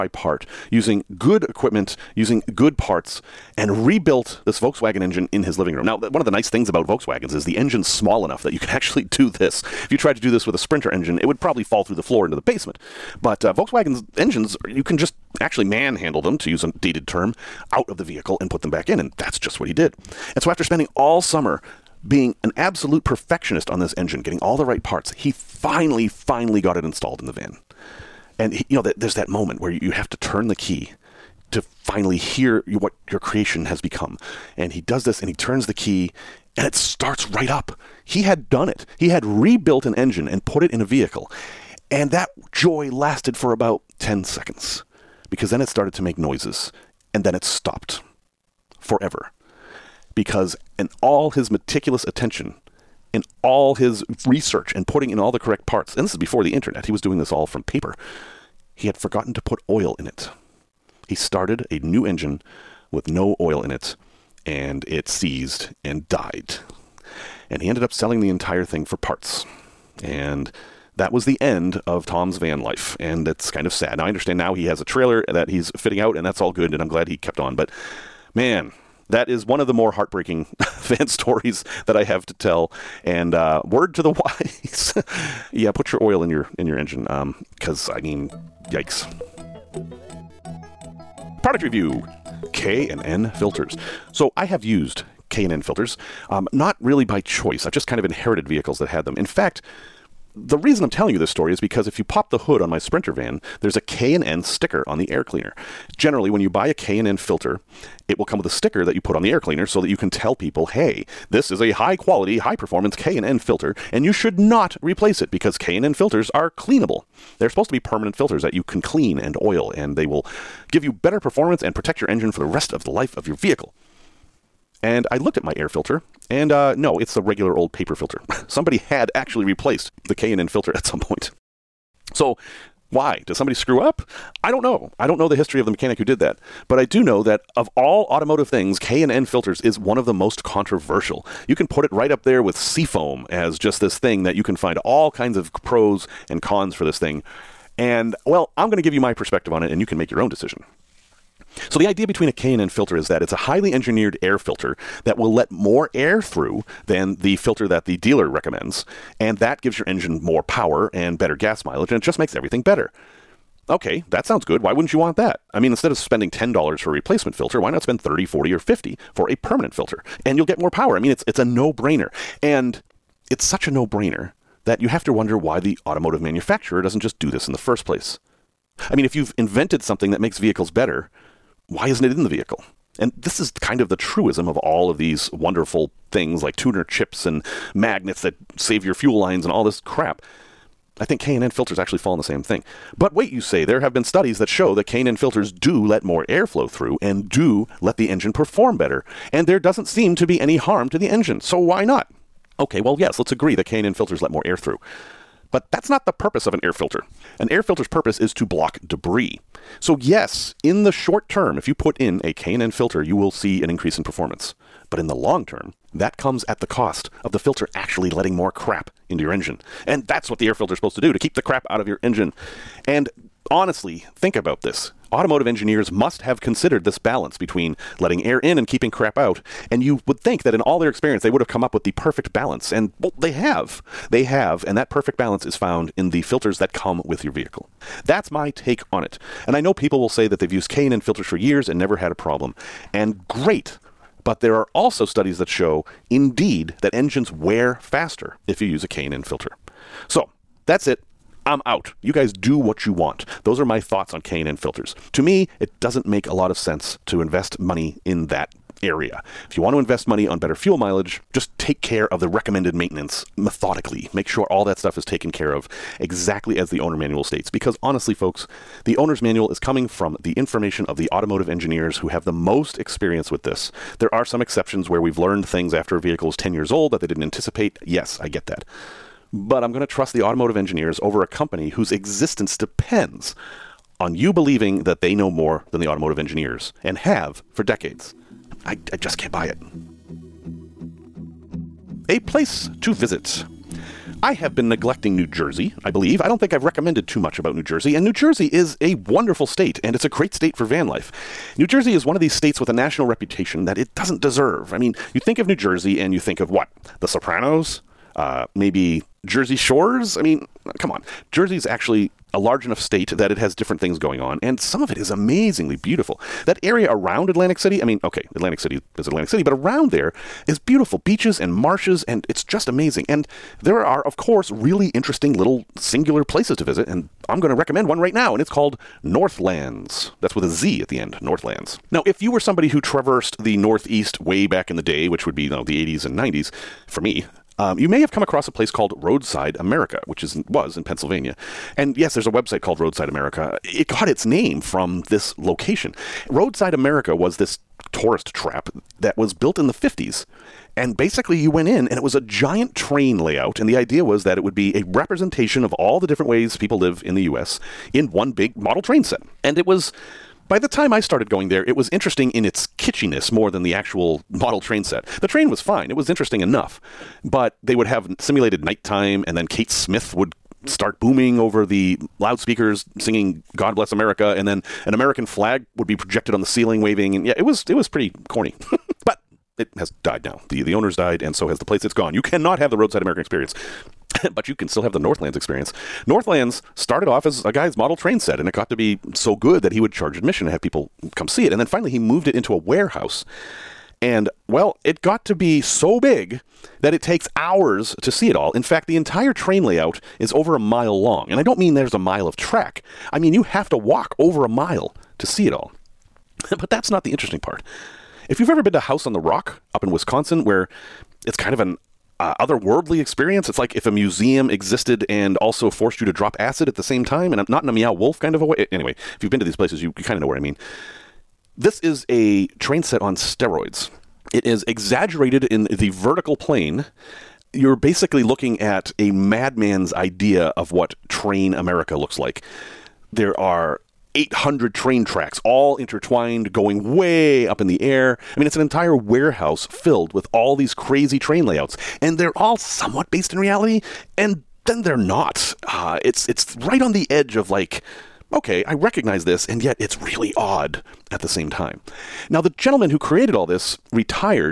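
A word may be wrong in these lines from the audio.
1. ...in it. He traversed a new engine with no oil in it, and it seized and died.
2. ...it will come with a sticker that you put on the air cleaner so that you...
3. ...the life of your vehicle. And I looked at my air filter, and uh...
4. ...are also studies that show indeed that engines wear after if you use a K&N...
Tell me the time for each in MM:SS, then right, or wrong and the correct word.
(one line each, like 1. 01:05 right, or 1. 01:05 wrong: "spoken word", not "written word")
1. 00:59 wrong: "started", not "traversed"
2. 01:48 right
3. 02:02 right
4. 04:04 wrong: "faster", not "after".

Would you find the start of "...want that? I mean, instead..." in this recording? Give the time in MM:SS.
02:44.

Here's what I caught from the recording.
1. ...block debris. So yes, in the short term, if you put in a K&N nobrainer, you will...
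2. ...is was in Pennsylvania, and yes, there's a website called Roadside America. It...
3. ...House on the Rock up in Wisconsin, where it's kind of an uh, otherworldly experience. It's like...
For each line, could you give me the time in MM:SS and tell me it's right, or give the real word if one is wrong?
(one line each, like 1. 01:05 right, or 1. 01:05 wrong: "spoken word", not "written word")
1. 03:28 wrong: "filter", not "nobrainer"
2. 05:40 right
3. 06:48 right.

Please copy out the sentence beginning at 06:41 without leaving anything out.
And I don't mean there's a mile of track, I mean, you have to walk over a mile to see it all.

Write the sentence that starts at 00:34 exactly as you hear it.
And he does this, and he turns the key, and it starts right up.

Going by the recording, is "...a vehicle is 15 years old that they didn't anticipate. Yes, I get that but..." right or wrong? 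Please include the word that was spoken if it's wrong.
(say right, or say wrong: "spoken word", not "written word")
wrong: "10", not "15".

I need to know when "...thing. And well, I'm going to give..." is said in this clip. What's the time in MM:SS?
02:26.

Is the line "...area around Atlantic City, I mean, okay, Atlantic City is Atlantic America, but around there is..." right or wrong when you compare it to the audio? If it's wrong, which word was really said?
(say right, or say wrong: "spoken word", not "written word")
wrong: "City", not "America".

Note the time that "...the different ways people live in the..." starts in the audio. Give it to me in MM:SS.
05:55.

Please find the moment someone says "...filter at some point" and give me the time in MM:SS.
02:10.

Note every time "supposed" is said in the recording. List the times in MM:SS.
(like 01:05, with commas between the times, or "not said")
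01:57, 03:40.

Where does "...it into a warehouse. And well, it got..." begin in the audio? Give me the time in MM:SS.
06:32.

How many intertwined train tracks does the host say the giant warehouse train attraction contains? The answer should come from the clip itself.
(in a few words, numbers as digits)
800.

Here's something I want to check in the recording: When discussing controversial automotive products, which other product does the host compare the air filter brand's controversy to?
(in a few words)
Seafoam.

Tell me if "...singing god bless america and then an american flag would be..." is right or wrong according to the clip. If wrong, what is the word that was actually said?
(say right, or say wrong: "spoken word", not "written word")
right.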